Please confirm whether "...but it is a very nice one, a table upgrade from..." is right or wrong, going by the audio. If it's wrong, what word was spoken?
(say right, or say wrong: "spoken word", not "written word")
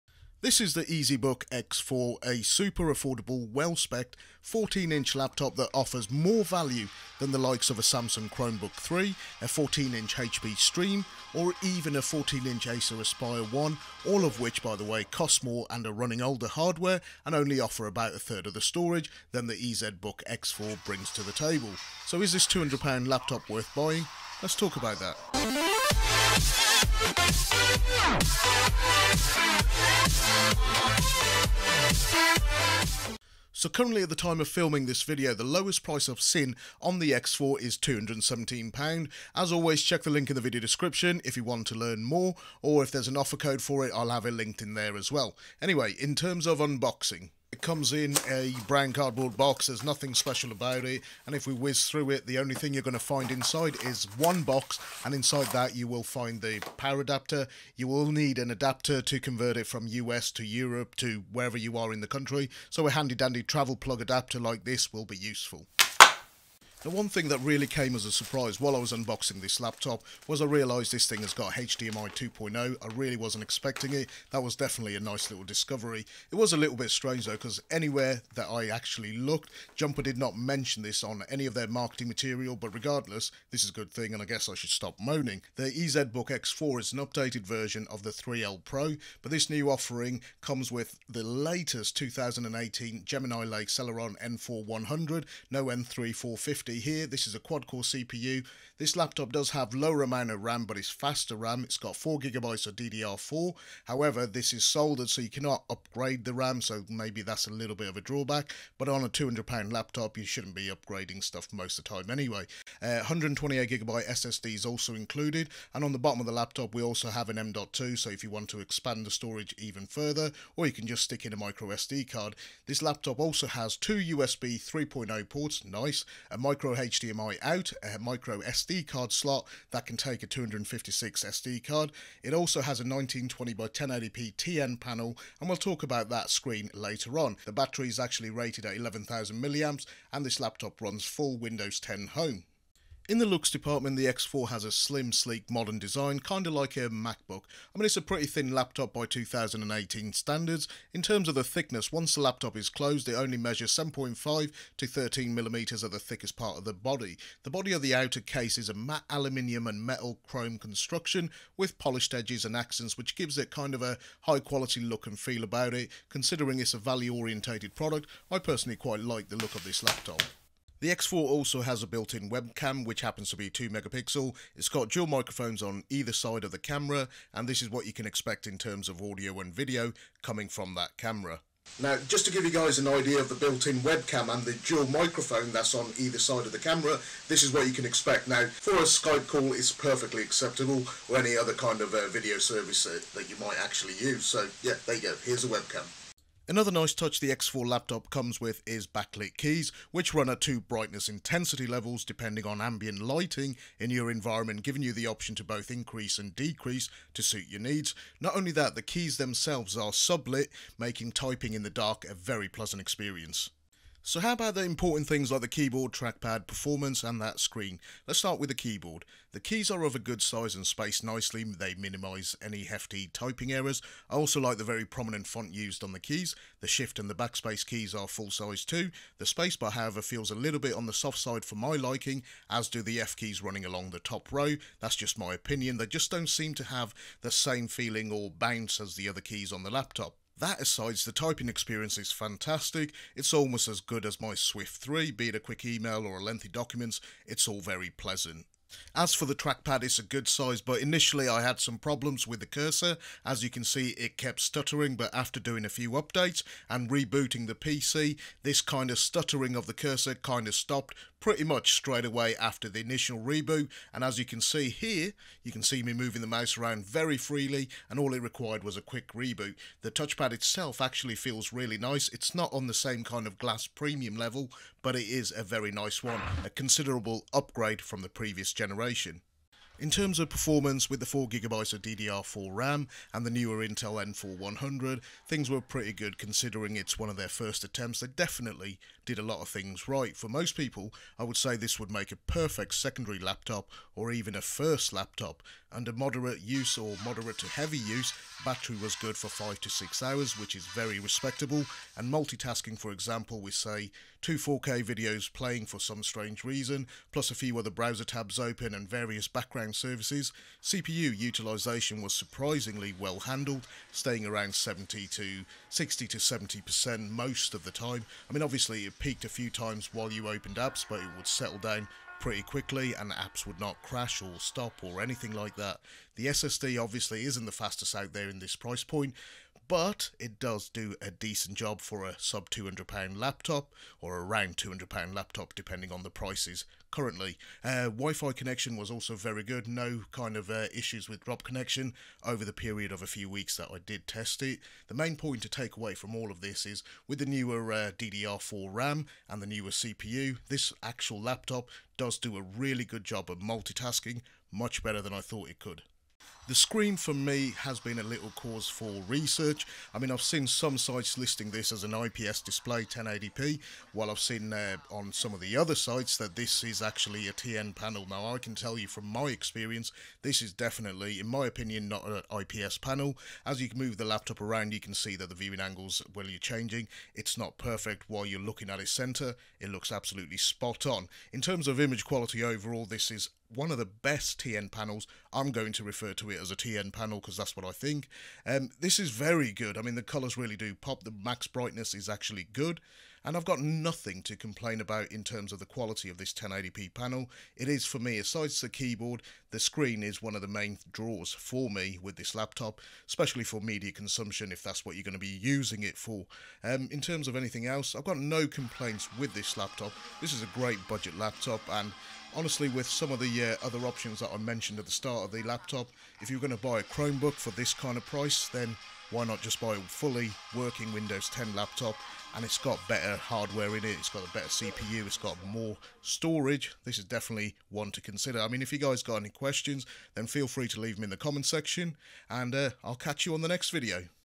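wrong: "considerable", not "table".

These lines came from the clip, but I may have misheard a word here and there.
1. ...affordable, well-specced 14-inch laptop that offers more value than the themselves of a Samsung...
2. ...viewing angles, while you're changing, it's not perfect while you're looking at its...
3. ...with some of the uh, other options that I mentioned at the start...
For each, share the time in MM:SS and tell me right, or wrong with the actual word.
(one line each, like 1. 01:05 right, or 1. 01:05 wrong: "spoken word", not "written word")
1. 00:02 wrong: "likes", not "themselves"
2. 06:15 right
3. 06:52 right.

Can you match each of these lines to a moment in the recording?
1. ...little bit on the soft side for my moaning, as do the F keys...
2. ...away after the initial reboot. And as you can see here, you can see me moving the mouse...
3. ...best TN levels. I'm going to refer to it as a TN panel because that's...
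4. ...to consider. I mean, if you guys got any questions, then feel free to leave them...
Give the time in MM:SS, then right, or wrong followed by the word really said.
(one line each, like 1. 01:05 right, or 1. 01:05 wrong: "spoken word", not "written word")
1. 03:50 wrong: "liking", not "moaning"
2. 04:22 right
3. 06:23 wrong: "panels", not "levels"
4. 07:07 right.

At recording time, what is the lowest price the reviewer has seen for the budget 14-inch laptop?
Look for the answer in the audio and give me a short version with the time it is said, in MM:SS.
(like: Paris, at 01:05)
£217, at 00:37.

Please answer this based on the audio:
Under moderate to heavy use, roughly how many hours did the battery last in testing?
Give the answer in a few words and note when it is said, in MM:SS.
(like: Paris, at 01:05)
5 to 6 hours, at 04:59.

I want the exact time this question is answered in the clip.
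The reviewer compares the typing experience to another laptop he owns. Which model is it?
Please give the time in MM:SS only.
04:04.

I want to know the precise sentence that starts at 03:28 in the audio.
Not only that, the keys themselves are sublit, making typing in the dark a very pleasant experience.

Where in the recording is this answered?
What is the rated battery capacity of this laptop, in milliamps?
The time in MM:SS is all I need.
02:18.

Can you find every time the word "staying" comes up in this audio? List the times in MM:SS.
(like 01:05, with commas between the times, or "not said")
05:13.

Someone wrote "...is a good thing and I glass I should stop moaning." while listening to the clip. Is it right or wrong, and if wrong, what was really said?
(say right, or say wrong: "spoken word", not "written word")
wrong: "guess", not "glass".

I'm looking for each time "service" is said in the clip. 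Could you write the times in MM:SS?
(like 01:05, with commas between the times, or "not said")
03:12, 05:09.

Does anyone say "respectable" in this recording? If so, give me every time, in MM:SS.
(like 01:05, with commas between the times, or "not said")
05:00.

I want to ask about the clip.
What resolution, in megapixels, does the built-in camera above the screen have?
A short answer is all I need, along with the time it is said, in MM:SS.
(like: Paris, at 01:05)
2 megapixel, at 02:53.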